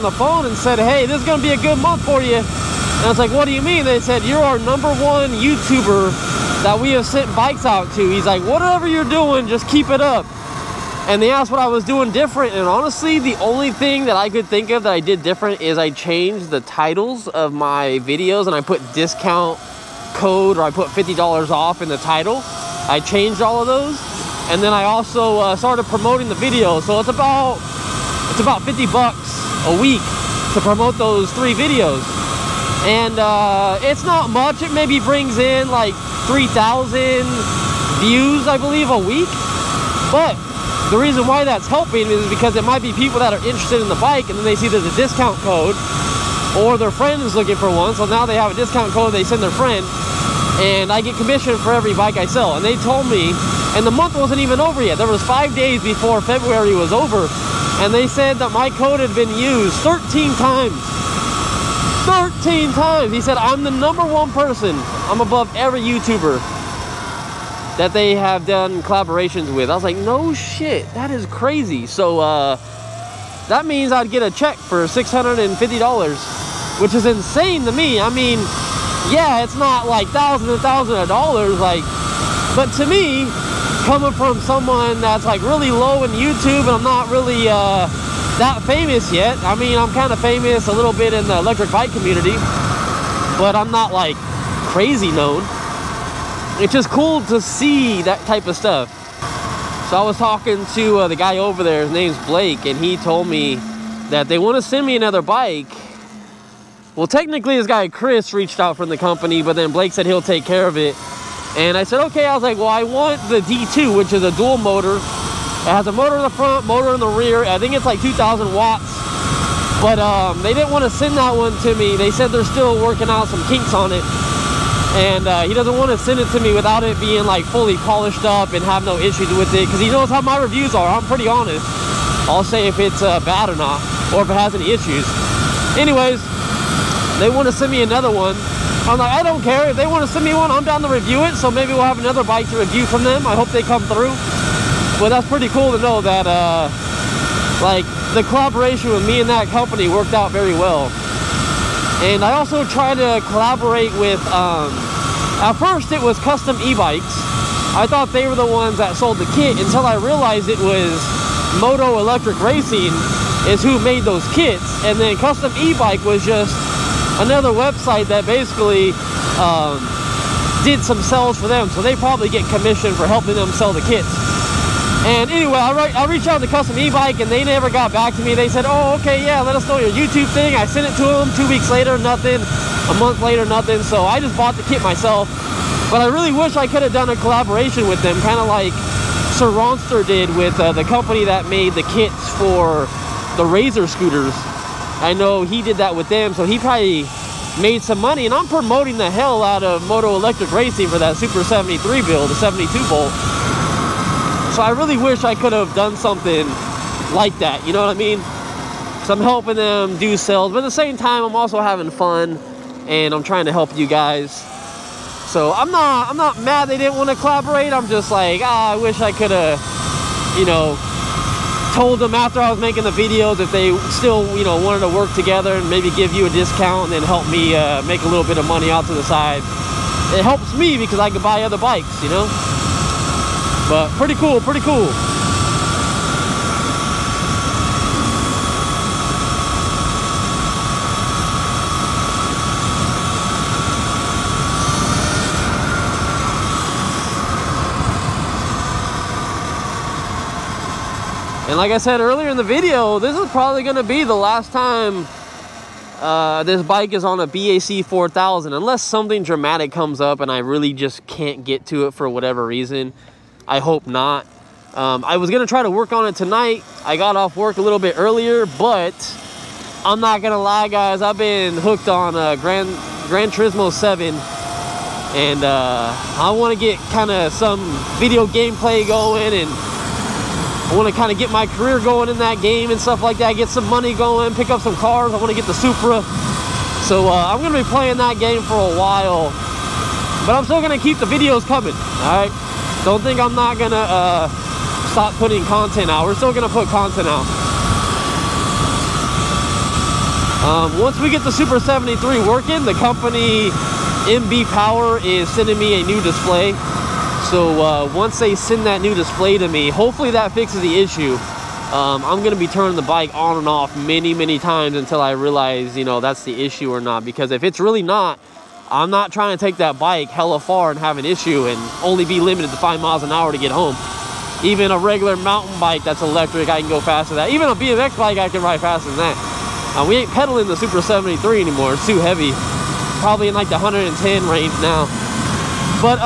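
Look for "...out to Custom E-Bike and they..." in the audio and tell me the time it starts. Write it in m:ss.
2:56.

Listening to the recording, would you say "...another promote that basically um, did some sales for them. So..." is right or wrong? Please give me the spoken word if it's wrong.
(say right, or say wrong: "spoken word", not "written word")
wrong: "website", not "promote".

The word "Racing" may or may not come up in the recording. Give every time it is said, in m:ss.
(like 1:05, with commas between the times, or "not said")
2:42, 3:20.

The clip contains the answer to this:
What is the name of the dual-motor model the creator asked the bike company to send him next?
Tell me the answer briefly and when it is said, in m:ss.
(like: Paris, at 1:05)
D2, at 1:53.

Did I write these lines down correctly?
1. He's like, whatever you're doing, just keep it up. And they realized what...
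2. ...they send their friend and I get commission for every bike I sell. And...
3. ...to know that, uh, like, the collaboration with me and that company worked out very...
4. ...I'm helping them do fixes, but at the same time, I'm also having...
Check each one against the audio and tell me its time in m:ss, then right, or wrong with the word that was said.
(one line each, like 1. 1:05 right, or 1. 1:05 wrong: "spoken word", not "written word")
1. 0:08 wrong: "asked", not "realized"
2. 0:49 right
3. 2:25 right
4. 3:29 wrong: "sales", not "fixes".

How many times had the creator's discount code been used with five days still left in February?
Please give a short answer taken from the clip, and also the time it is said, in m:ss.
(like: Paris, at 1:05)
13, at 1:02.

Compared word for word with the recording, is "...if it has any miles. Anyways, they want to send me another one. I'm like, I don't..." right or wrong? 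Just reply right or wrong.
wrong.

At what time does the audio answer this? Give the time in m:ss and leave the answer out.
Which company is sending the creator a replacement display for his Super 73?
5:04.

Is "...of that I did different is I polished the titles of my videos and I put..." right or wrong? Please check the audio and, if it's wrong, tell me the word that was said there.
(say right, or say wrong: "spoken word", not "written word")
wrong: "changed", not "polished".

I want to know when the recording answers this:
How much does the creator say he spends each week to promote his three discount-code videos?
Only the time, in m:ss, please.
0:28.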